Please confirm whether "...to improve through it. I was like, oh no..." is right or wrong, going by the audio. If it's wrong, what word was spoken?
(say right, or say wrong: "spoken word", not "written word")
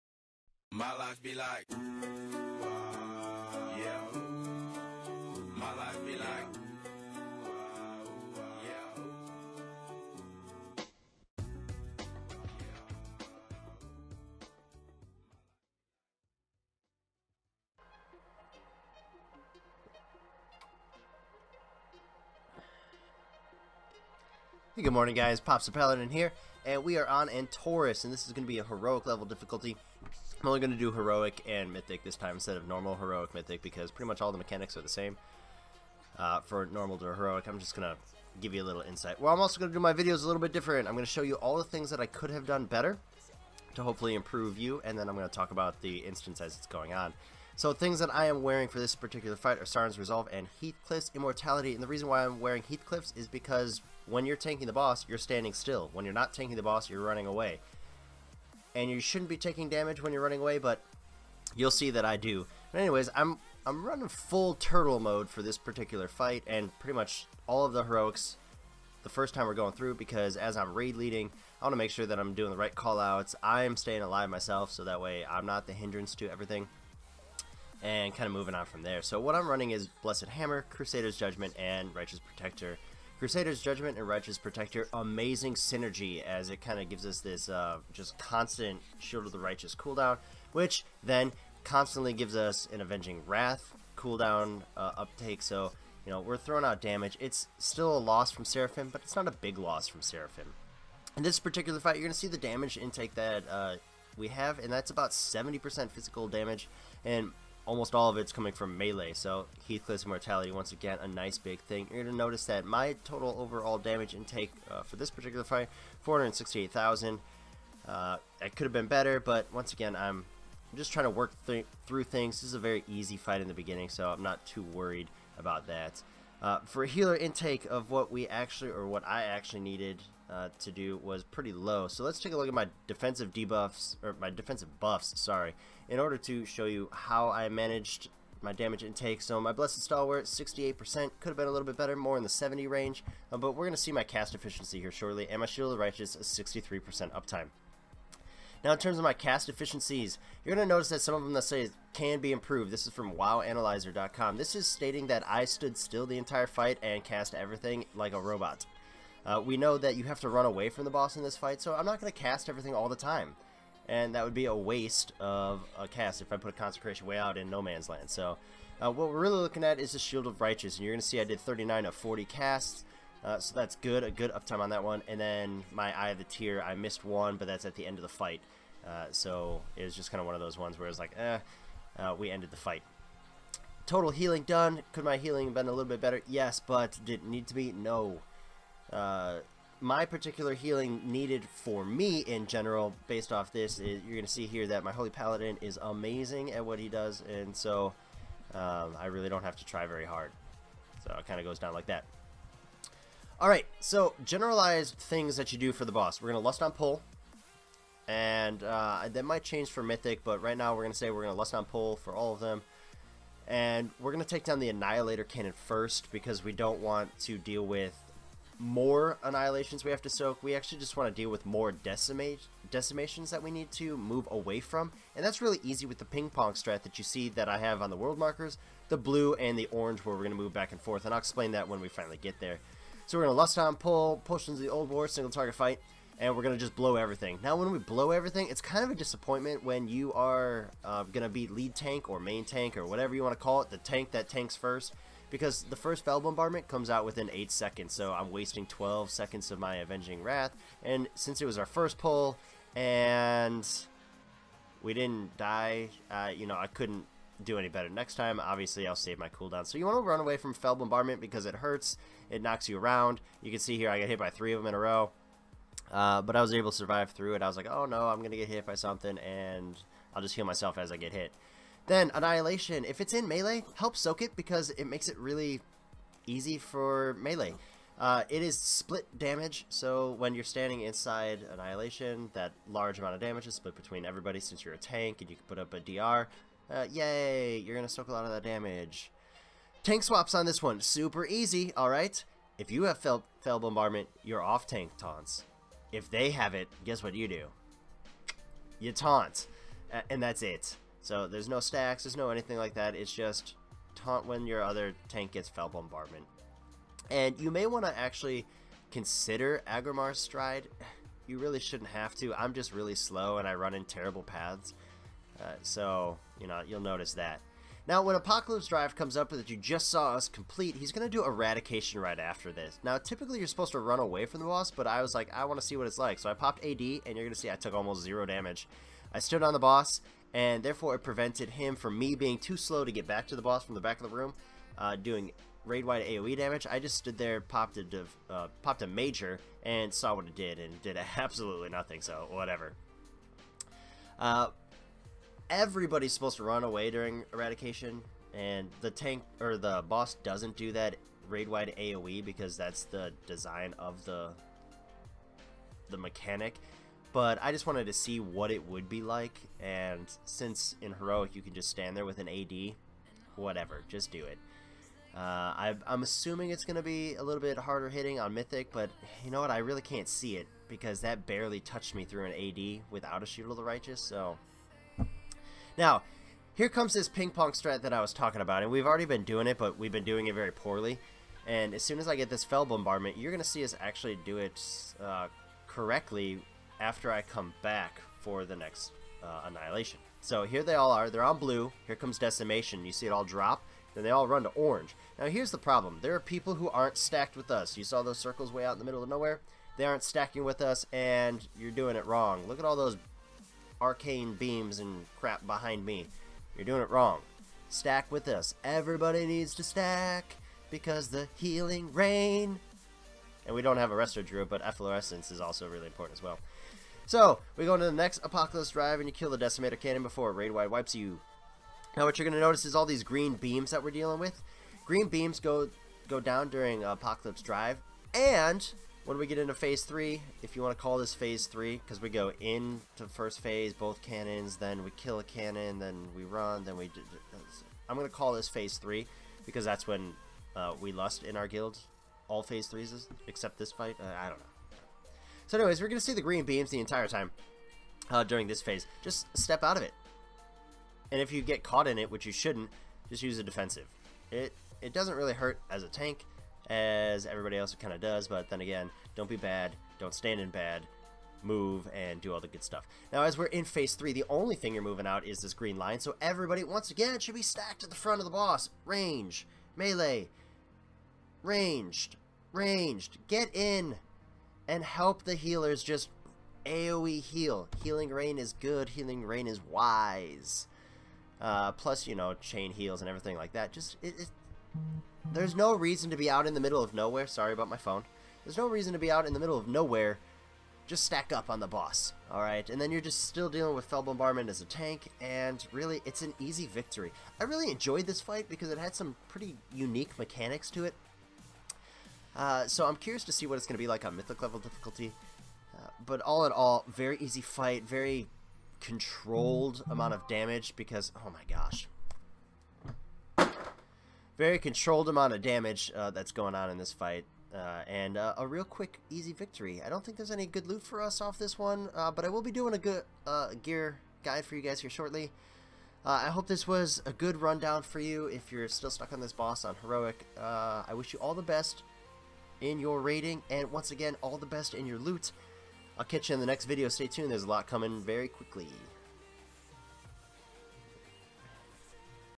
wrong: "survive", not "improve".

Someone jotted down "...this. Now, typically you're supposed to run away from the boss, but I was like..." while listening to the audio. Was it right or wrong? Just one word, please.
right.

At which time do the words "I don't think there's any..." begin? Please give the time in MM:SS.
08:39.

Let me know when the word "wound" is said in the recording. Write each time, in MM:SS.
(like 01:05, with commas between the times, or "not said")
not said.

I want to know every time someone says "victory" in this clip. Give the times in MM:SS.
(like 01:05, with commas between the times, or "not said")
08:16, 08:39.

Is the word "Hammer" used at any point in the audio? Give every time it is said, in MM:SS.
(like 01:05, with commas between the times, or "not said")
01:20.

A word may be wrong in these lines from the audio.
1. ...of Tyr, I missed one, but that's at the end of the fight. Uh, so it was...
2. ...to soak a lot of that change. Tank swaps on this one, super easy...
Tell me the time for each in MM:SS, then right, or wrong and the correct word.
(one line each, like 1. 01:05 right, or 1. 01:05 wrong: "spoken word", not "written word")
1. 02:56 right
2. 04:47 wrong: "damage", not "change".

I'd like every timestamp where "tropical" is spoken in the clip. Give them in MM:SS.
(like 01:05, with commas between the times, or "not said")
not said.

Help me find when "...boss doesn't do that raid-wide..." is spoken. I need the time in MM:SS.
05:49.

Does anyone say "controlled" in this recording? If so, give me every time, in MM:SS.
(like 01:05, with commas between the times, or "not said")
08:28, 08:34.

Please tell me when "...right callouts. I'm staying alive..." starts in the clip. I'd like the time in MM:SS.
01:12.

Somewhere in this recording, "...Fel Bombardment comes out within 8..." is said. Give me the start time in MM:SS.
04:06.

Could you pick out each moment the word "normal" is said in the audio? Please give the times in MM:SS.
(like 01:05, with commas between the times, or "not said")
00:32, 00:36.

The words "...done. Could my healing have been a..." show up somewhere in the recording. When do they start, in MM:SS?
03:04.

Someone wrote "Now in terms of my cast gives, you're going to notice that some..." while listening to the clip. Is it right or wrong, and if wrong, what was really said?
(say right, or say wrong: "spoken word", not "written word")
wrong: "efficiencies", not "gives".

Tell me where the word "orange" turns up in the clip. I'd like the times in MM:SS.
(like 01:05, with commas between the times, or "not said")
03:49, 06:34.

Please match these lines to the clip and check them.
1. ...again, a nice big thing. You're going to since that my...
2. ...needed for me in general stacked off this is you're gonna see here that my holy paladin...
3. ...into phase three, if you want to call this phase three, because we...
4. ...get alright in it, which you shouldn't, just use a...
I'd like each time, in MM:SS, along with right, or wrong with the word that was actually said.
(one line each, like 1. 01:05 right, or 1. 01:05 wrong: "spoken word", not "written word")
1. 01:50 wrong: "notice", not "since"
2. 03:11 wrong: "based", not "stacked"
3. 07:09 right
4. 07:31 wrong: "caught", not "alright".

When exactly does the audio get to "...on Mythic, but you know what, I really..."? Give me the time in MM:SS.
06:08.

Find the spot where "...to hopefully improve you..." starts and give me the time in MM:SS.
00:43.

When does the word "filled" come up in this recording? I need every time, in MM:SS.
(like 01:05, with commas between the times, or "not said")
not said.